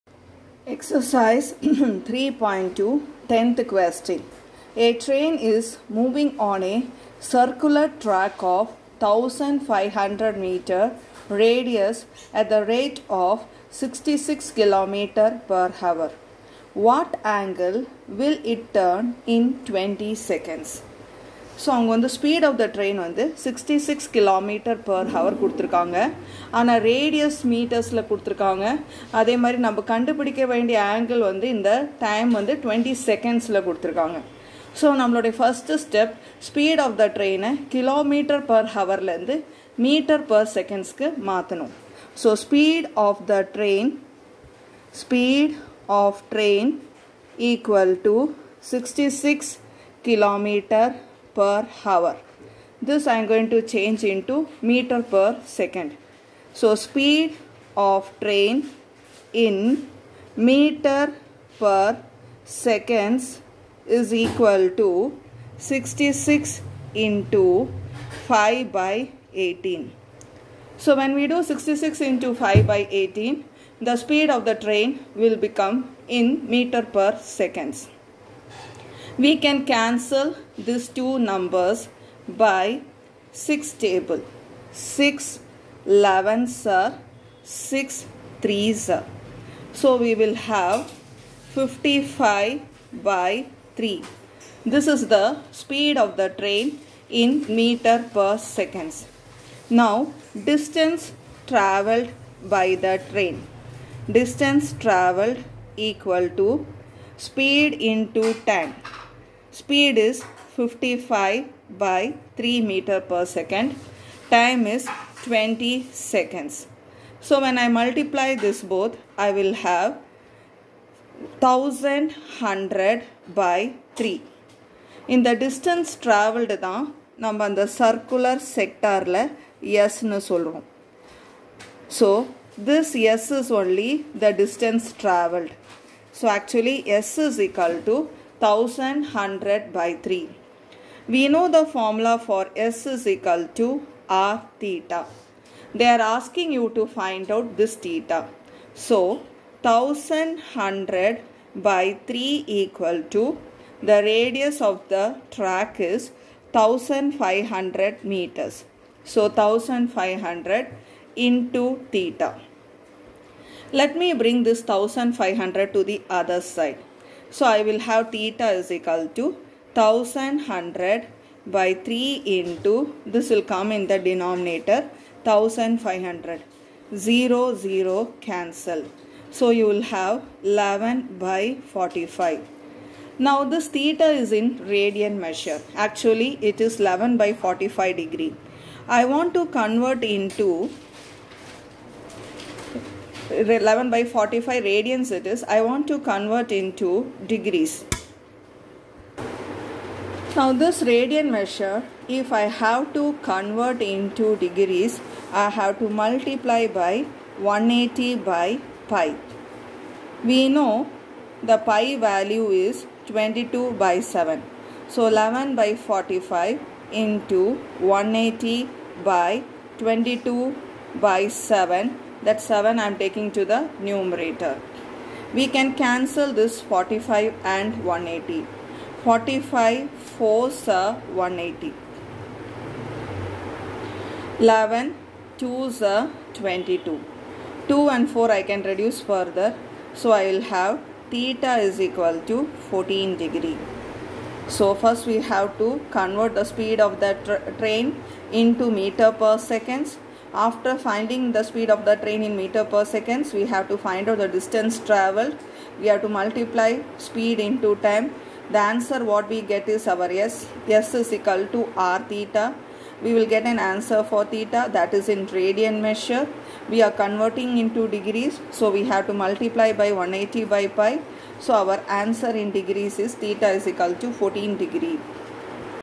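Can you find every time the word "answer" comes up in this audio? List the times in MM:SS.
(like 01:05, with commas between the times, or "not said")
04:18, 04:23, 04:31.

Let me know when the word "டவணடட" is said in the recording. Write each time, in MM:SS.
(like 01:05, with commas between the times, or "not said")
00:32.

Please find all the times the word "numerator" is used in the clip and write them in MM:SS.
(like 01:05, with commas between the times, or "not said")
03:43.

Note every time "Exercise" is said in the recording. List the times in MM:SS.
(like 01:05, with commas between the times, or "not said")
00:00.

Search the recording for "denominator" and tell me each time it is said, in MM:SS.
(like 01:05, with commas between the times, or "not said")
02:54.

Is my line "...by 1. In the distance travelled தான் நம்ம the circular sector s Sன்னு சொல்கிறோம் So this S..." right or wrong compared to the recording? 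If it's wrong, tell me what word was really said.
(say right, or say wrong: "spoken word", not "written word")
wrong: "3", not "1".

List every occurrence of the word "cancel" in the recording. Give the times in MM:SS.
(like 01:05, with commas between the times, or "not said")
01:19, 02:58, 03:45.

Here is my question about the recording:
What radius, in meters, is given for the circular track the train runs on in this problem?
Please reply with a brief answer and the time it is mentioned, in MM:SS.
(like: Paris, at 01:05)
1500 meters, at 00:08.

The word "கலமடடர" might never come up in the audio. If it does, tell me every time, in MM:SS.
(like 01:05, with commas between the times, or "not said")
00:24, 00:37, 00:50.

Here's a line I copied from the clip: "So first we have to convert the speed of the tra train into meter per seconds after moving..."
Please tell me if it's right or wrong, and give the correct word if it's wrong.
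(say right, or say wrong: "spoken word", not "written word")
wrong: "finding", not "moving".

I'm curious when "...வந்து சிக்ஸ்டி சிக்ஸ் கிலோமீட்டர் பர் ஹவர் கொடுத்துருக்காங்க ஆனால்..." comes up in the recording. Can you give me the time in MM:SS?
00:23.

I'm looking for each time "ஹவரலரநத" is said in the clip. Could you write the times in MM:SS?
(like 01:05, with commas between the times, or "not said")
00:38.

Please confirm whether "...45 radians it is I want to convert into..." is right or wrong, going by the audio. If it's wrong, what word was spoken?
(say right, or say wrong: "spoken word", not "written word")
right.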